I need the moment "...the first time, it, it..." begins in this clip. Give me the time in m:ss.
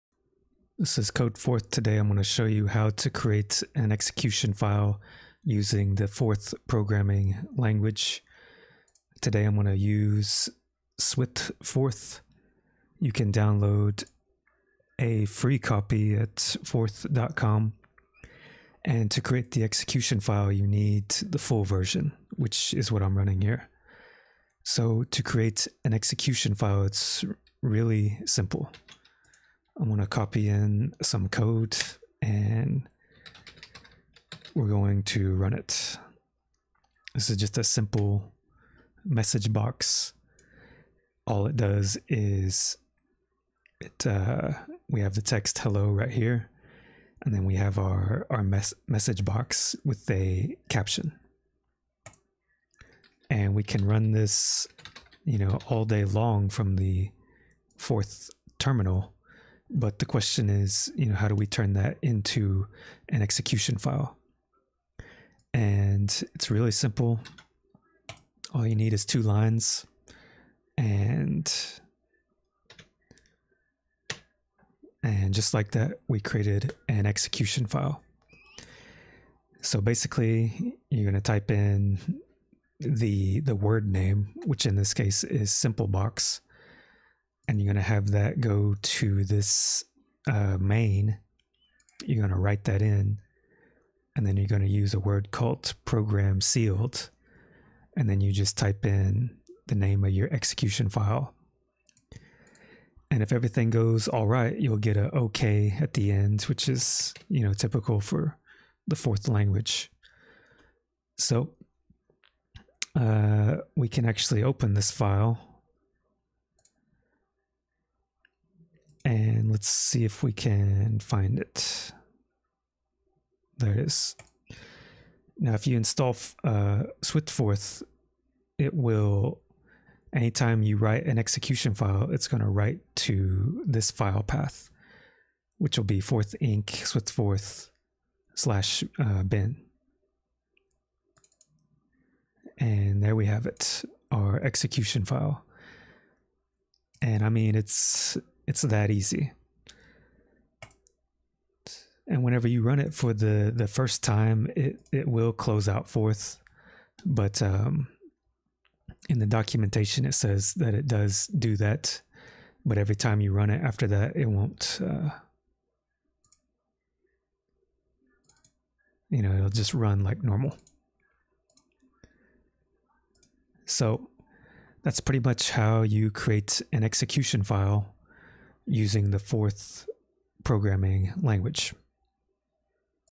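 2:33.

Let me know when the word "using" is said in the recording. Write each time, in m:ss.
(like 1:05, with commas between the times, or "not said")
0:05, 2:58.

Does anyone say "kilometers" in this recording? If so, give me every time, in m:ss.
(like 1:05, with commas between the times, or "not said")
not said.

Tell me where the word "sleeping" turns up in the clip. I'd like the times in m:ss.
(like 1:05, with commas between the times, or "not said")
not said.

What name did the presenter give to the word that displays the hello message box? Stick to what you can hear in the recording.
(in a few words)
simple box.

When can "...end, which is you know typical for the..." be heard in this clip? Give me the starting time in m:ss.
1:46.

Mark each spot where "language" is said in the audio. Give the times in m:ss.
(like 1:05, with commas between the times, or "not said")
0:07, 1:49, 3:01.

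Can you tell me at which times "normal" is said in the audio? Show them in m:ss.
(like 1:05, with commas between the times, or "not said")
2:50.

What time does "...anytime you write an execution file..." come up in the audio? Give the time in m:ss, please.
2:10.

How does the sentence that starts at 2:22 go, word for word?
And there we have it, our execution file.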